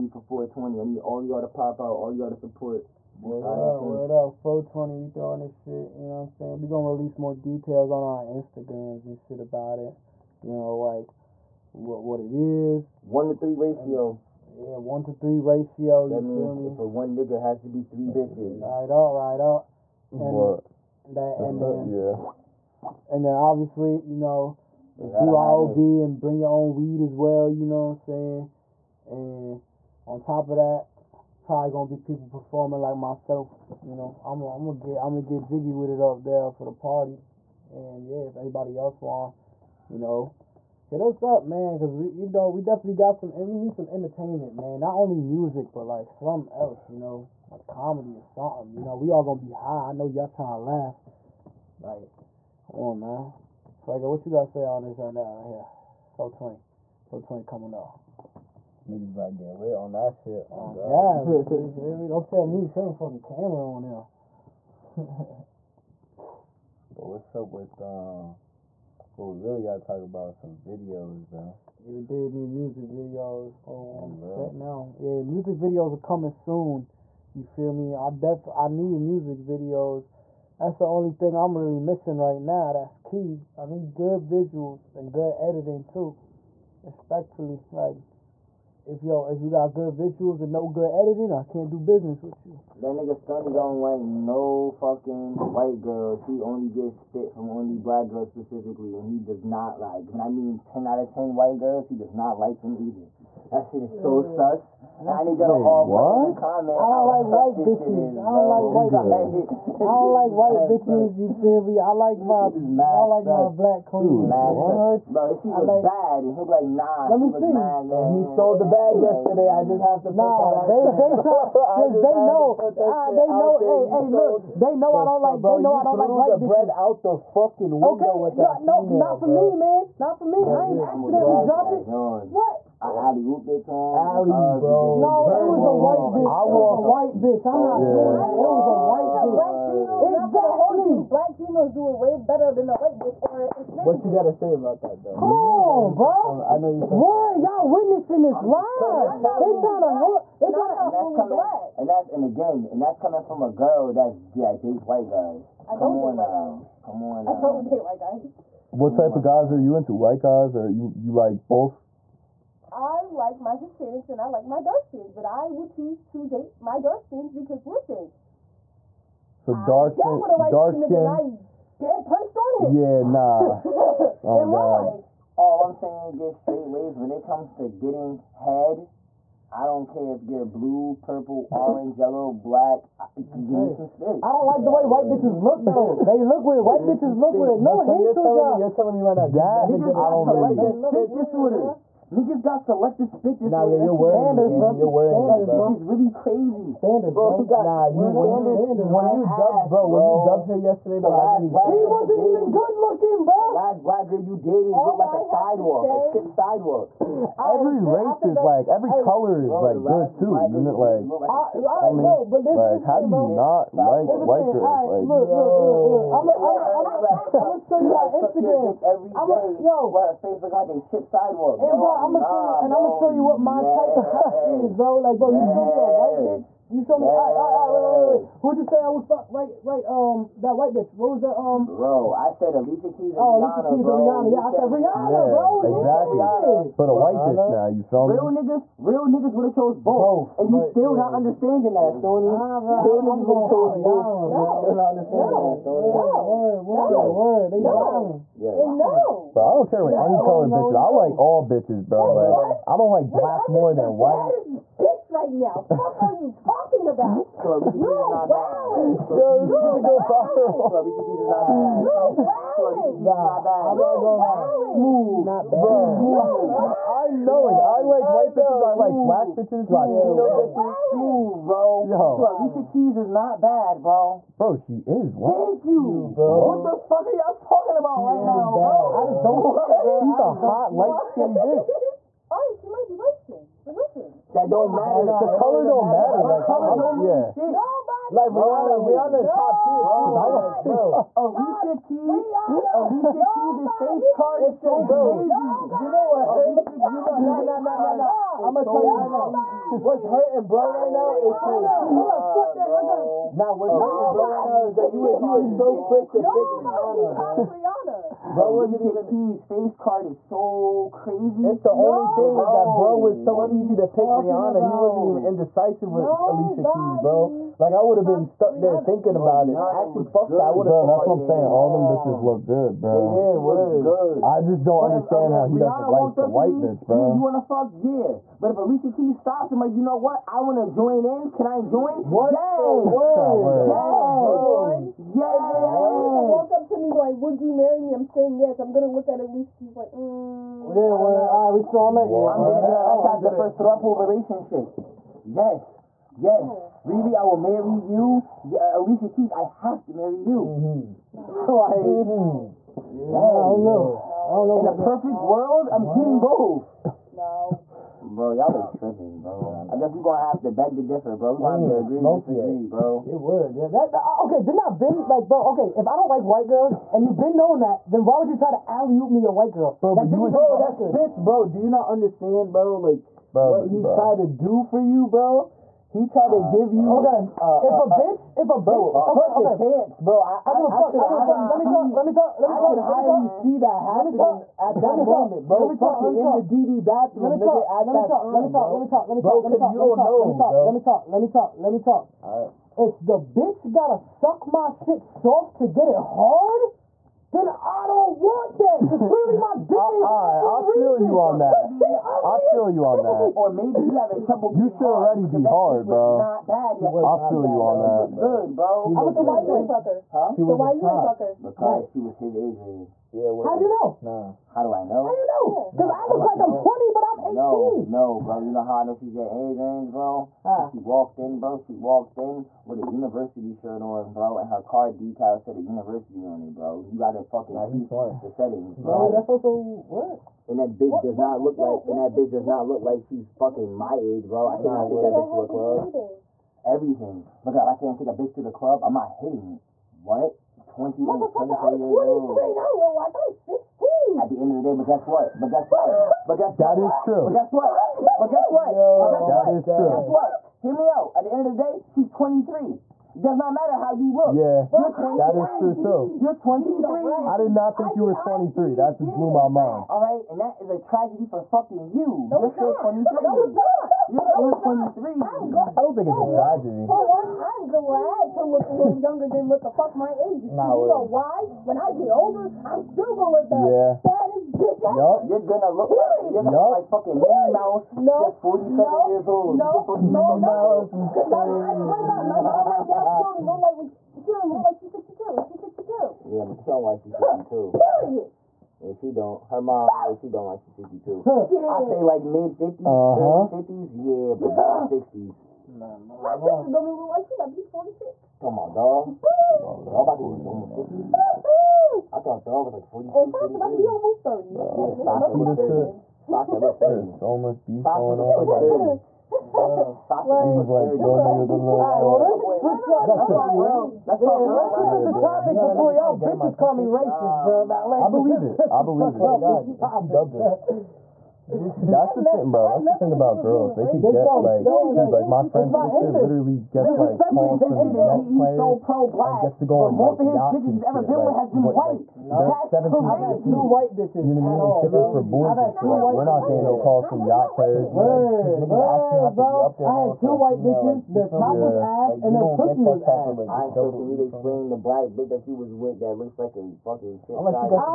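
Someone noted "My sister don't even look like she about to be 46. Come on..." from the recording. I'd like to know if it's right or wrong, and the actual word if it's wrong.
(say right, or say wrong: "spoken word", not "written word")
right.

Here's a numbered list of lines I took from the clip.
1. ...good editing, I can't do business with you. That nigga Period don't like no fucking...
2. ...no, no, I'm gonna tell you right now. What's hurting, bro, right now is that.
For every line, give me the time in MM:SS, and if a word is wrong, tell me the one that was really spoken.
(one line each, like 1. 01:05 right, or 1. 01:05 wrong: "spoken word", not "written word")
1. 01:30 wrong: "Stunny", not "Period"
2. 04:57 right.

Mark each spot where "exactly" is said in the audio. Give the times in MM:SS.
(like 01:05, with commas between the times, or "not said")
02:20, 03:55.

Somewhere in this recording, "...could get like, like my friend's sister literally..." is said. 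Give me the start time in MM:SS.
08:43.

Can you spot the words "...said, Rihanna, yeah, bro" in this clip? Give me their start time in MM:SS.
03:54.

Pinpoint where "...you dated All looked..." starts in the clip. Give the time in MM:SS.
03:24.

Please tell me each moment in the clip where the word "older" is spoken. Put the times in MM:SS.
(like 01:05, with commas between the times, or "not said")
07:52.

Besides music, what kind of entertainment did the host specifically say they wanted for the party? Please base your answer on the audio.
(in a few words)
Comedy.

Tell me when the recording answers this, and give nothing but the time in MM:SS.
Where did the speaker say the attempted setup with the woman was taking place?
06:26.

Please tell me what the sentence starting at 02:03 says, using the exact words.
Hey, hey, look, they know I don't like.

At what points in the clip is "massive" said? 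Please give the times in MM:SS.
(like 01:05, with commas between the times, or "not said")
not said.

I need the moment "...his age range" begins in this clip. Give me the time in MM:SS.
06:52.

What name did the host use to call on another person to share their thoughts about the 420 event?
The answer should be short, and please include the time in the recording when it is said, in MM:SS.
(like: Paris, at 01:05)
Fuego, at 00:53.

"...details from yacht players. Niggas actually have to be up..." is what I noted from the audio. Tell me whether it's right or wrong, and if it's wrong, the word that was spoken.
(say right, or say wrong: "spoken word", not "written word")
wrong: "calls", not "details".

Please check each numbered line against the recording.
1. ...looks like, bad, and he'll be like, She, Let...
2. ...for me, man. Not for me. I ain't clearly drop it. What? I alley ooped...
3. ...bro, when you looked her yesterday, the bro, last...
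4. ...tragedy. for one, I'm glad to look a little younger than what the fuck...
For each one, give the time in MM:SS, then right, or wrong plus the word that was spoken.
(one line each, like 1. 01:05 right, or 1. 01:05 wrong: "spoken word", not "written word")
1. 01:55 wrong: "Nah", not "She"
2. 02:09 wrong: "accidentally", not "clearly"
3. 03:19 wrong: "dumped", not "looked"
4. 07:46 right.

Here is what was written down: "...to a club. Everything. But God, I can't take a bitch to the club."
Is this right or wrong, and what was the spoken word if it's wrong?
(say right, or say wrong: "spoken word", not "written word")
right.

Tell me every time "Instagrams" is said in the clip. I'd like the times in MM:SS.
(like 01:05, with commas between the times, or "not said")
00:08, 03:38.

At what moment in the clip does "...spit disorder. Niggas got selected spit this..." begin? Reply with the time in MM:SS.
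03:10.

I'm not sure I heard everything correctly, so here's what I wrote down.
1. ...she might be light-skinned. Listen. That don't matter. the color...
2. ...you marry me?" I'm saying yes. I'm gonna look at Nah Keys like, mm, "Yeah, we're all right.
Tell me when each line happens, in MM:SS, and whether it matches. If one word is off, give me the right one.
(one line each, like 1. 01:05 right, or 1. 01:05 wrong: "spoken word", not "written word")
1. 04:42 right
2. 05:37 wrong: "Alicia", not "Nah".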